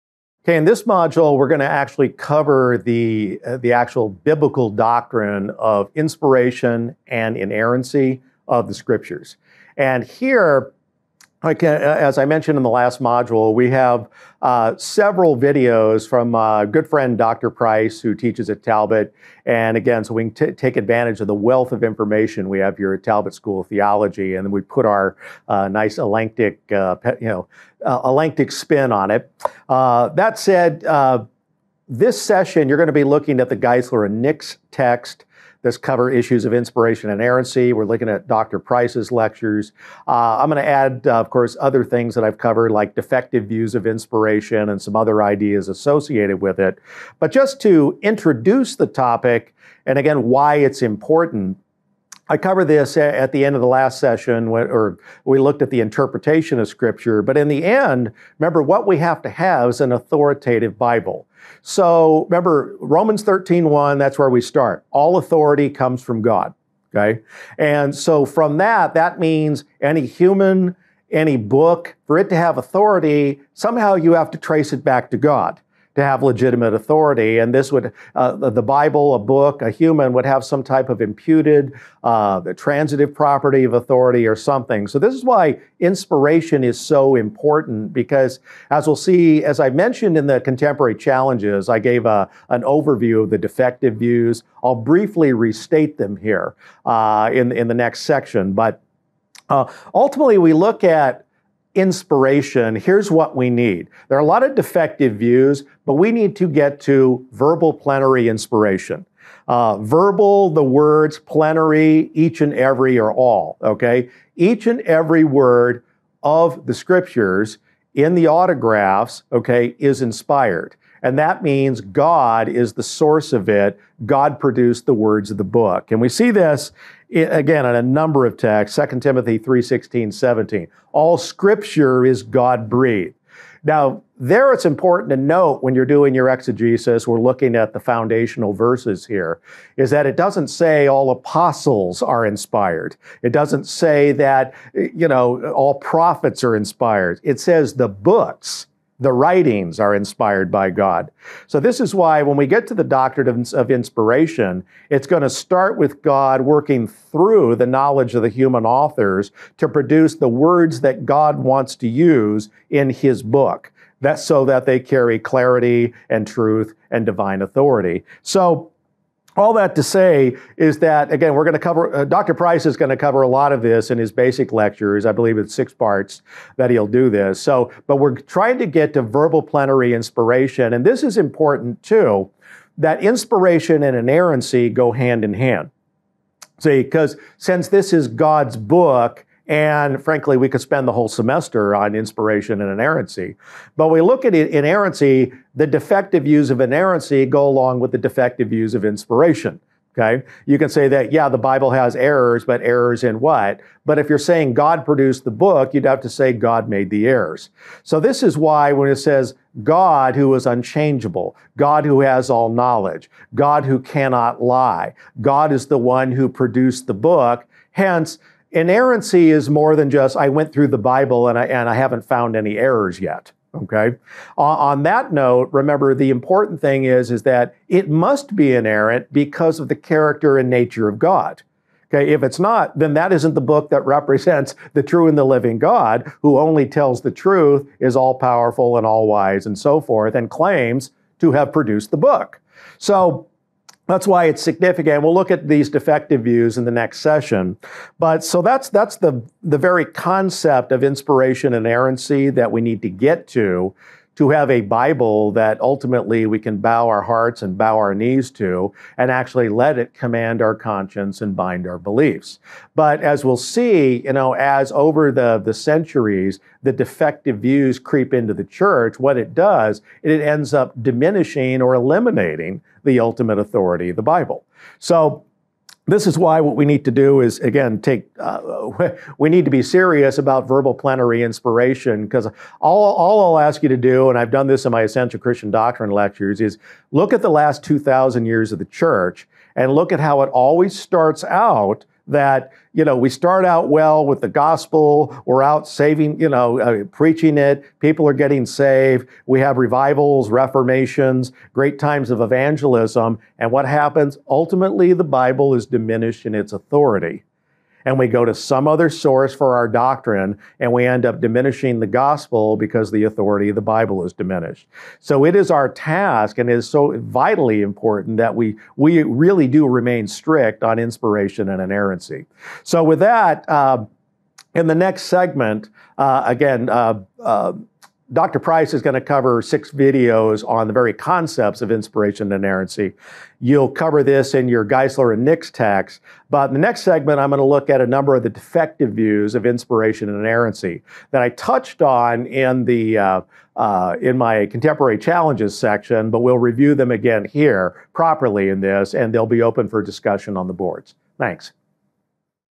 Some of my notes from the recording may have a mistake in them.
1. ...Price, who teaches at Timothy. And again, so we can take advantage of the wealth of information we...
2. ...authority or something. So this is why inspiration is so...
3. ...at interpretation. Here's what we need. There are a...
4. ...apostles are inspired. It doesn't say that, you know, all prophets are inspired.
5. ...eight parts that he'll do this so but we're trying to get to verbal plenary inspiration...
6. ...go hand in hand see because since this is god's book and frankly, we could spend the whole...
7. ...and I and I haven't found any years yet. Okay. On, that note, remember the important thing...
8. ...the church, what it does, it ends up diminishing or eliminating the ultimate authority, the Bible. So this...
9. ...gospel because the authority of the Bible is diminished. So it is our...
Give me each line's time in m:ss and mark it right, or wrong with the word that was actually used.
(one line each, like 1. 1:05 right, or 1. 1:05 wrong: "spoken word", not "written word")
1. 0:17 wrong: "Talbot", not "Timothy"
2. 1:23 right
3. 1:40 wrong: "inspiration", not "interpretation"
4. 2:21 right
5. 2:55 wrong: "six", not "eight"
6. 3:04 right
7. 3:41 wrong: "errors", not "years"
8. 4:28 right
9. 5:11 right.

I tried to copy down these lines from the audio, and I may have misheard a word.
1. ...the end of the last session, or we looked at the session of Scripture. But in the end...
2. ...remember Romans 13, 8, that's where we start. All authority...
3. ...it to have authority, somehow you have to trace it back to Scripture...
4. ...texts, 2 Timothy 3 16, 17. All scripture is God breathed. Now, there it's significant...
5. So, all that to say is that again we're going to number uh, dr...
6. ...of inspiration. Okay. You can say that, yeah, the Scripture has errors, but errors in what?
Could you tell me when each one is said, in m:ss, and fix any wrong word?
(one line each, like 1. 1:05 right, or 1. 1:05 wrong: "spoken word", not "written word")
1. 0:53 wrong: "interpretation", not "session"
2. 1:02 wrong: "1", not "8"
3. 1:12 wrong: "God", not "Scripture"
4. 2:08 wrong: "important", not "significant"
5. 2:48 wrong: "cover", not "number"
6. 3:18 wrong: "Bible", not "Scripture".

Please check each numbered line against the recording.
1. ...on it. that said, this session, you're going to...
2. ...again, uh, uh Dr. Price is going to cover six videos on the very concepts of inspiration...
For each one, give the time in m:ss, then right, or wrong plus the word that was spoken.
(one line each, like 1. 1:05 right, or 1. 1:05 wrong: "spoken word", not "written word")
1. 0:28 right
2. 5:26 right.